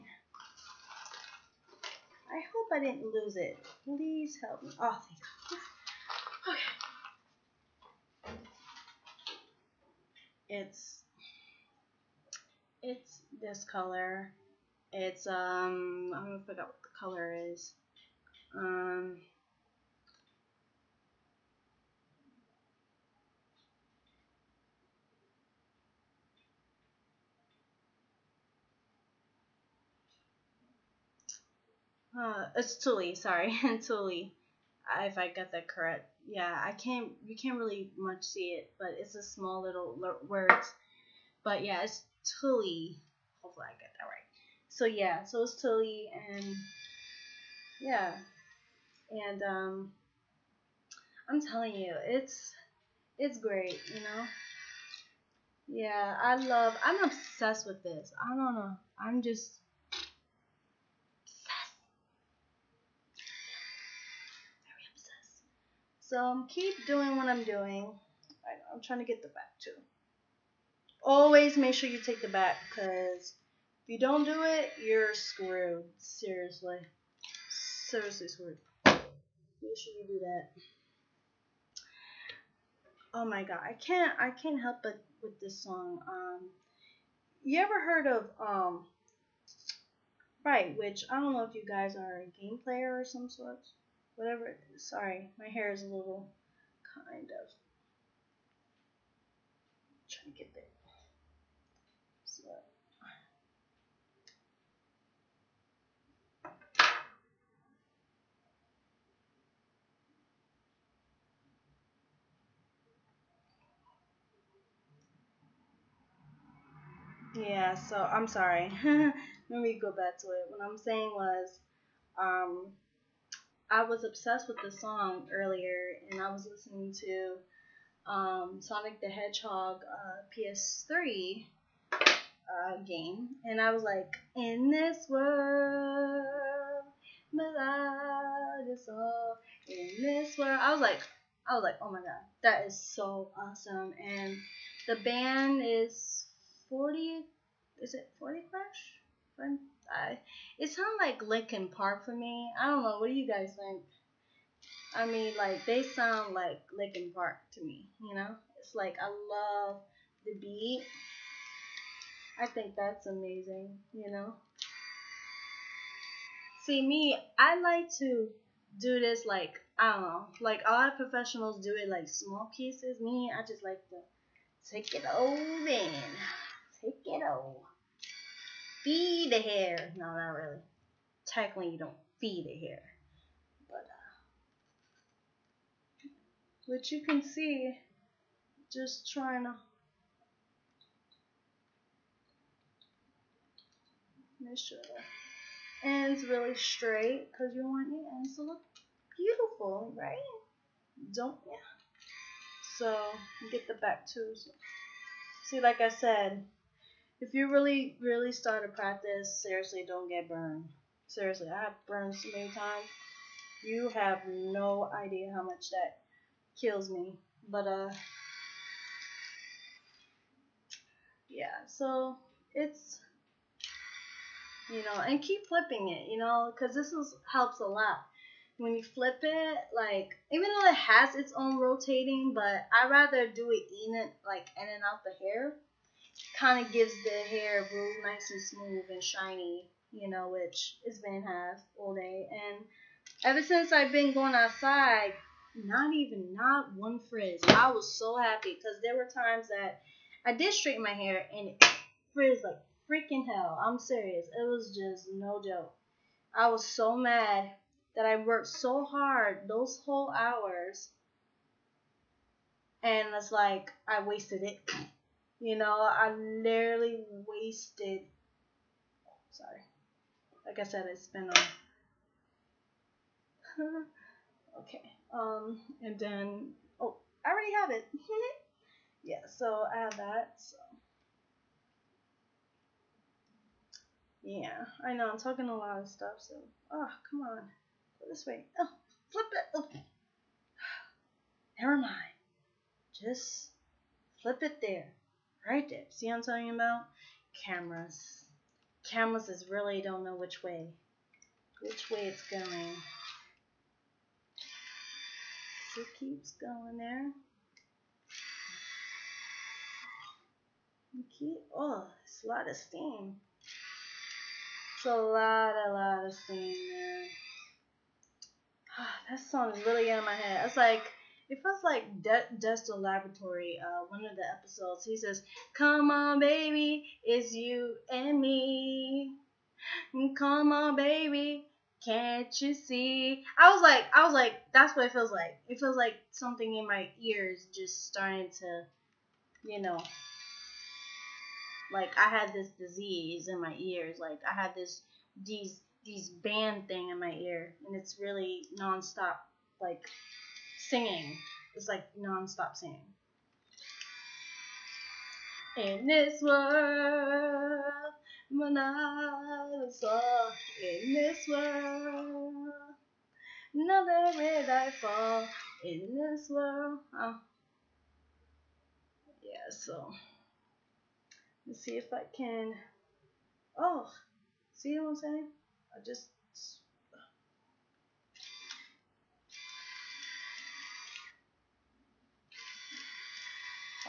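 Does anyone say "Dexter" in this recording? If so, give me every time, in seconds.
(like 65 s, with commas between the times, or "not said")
322 s.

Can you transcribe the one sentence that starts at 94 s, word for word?
Whatever sorry, my hair is a little kind of I'm trying to get there.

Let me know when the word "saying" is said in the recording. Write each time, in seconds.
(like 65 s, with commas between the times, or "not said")
120 s, 374 s.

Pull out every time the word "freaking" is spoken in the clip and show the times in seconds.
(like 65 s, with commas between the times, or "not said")
252 s.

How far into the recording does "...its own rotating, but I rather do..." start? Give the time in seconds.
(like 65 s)
231 s.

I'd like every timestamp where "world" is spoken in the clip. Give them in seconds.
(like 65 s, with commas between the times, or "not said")
135 s, 140 s, 356 s, 361 s, 366 s.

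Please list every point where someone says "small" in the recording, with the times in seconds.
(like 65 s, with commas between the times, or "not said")
39 s, 172 s.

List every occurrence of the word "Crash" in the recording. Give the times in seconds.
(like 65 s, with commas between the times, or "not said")
148 s.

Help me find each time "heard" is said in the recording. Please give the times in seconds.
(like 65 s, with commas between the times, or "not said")
87 s.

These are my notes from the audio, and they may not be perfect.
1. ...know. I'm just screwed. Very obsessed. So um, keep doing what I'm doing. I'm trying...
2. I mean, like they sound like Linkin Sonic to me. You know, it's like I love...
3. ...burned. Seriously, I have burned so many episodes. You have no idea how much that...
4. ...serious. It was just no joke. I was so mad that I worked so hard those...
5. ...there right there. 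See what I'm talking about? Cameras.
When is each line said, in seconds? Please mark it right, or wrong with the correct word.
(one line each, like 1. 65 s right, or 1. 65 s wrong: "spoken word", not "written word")
1. 58 s wrong: "obsessed", not "screwed"
2. 154 s wrong: "Park", not "Sonic"
3. 210 s wrong: "times", not "episodes"
4. 253 s right
5. 294 s right.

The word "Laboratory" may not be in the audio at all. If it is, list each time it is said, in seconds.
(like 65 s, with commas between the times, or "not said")
322 s.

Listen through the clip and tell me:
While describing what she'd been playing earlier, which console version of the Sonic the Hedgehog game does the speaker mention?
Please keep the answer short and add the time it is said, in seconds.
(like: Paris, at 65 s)
PS3, at 130 s.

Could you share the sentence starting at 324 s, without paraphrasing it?
He says, Come on, baby, it's you and me.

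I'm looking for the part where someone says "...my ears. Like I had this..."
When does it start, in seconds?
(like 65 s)
343 s.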